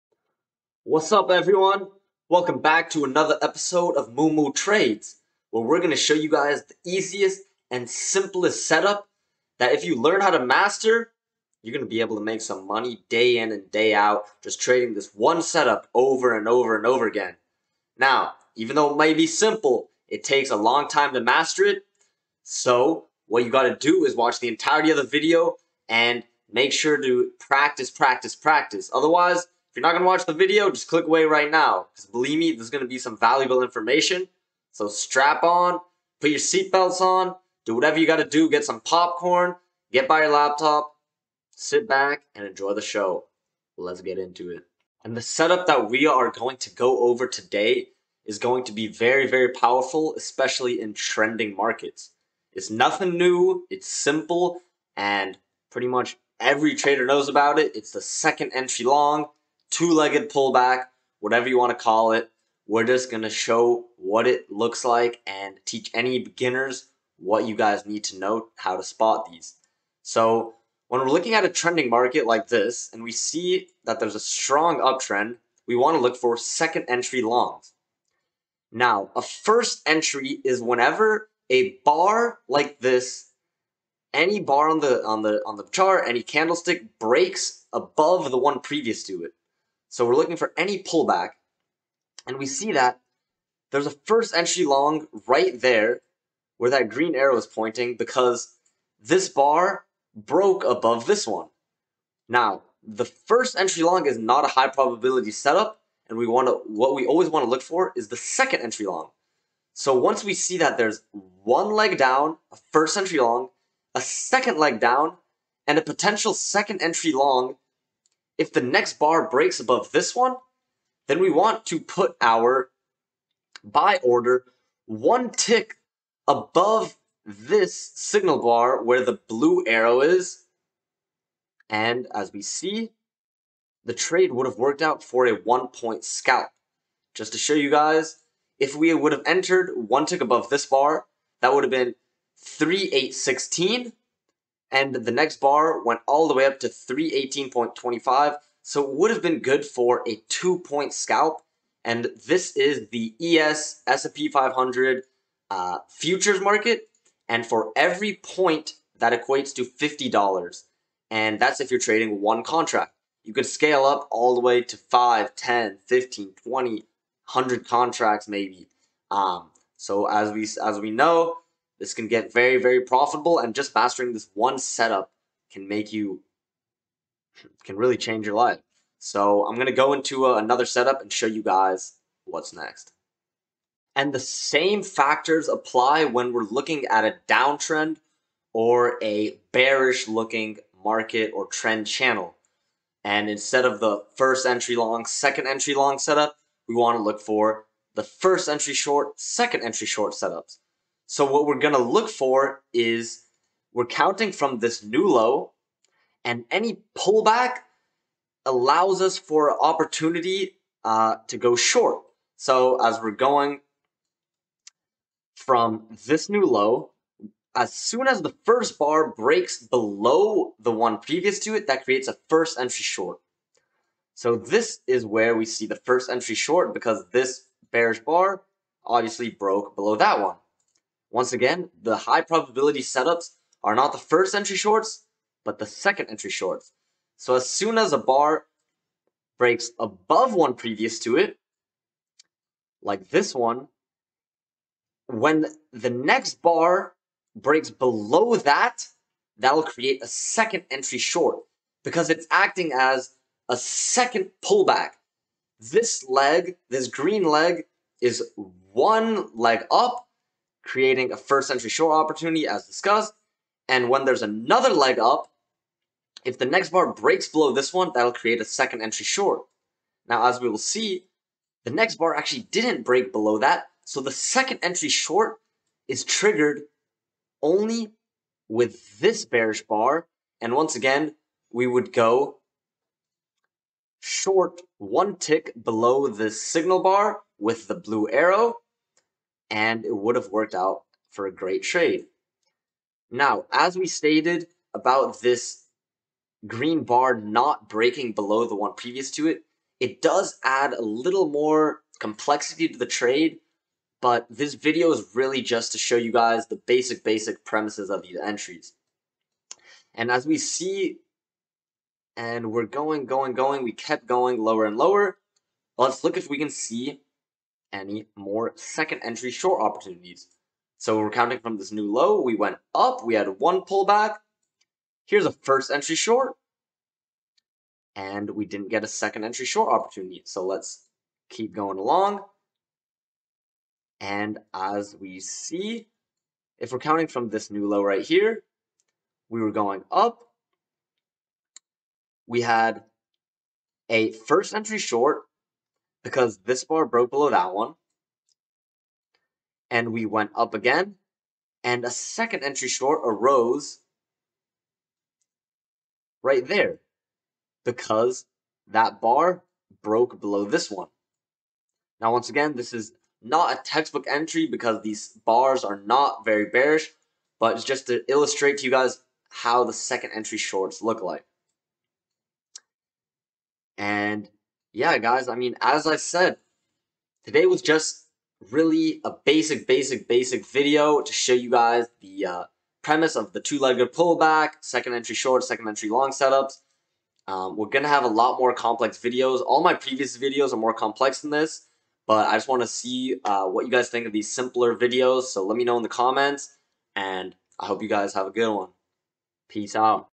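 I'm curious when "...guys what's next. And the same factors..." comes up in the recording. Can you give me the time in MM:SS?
03:01.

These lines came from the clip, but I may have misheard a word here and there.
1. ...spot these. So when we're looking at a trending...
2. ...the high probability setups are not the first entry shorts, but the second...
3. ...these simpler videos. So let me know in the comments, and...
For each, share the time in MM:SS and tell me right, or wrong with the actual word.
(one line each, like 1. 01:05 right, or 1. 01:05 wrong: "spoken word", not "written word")
1. 01:08 right
2. 03:51 right
3. 06:34 right.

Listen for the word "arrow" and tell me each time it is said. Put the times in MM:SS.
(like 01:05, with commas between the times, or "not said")
01:37, 02:09, 04:48.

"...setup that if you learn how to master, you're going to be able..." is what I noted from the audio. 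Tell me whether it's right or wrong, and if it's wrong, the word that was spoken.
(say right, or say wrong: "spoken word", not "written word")
right.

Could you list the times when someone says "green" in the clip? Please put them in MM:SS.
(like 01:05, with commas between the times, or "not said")
01:36, 04:16, 04:56.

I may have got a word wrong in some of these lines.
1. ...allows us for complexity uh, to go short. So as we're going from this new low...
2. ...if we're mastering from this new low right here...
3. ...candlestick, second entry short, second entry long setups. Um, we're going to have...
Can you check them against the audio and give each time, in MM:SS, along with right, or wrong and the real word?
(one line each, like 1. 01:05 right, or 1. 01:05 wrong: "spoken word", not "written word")
1. 03:28 wrong: "opportunity", not "complexity"
2. 05:36 wrong: "counting", not "mastering"
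3. 06:23 wrong: "pullback", not "candlestick".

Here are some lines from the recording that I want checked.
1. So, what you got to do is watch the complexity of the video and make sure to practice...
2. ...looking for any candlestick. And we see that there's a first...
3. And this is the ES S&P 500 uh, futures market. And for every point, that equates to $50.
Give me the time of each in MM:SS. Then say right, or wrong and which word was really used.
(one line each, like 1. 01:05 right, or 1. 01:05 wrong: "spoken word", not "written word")
1. 00:22 wrong: "entirety", not "complexity"
2. 01:30 wrong: "pullback", not "candlestick"
3. 02:31 right.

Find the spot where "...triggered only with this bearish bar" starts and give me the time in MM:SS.
04:36.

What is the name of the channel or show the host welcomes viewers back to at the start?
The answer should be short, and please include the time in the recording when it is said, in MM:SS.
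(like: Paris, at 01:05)
Moo Moo Trades, at 00:04.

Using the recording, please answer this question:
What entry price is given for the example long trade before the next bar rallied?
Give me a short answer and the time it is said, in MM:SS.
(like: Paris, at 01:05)
3816, at 02:22.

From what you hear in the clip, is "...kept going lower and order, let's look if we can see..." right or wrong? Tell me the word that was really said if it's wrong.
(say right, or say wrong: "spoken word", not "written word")
wrong: "lower", not "order".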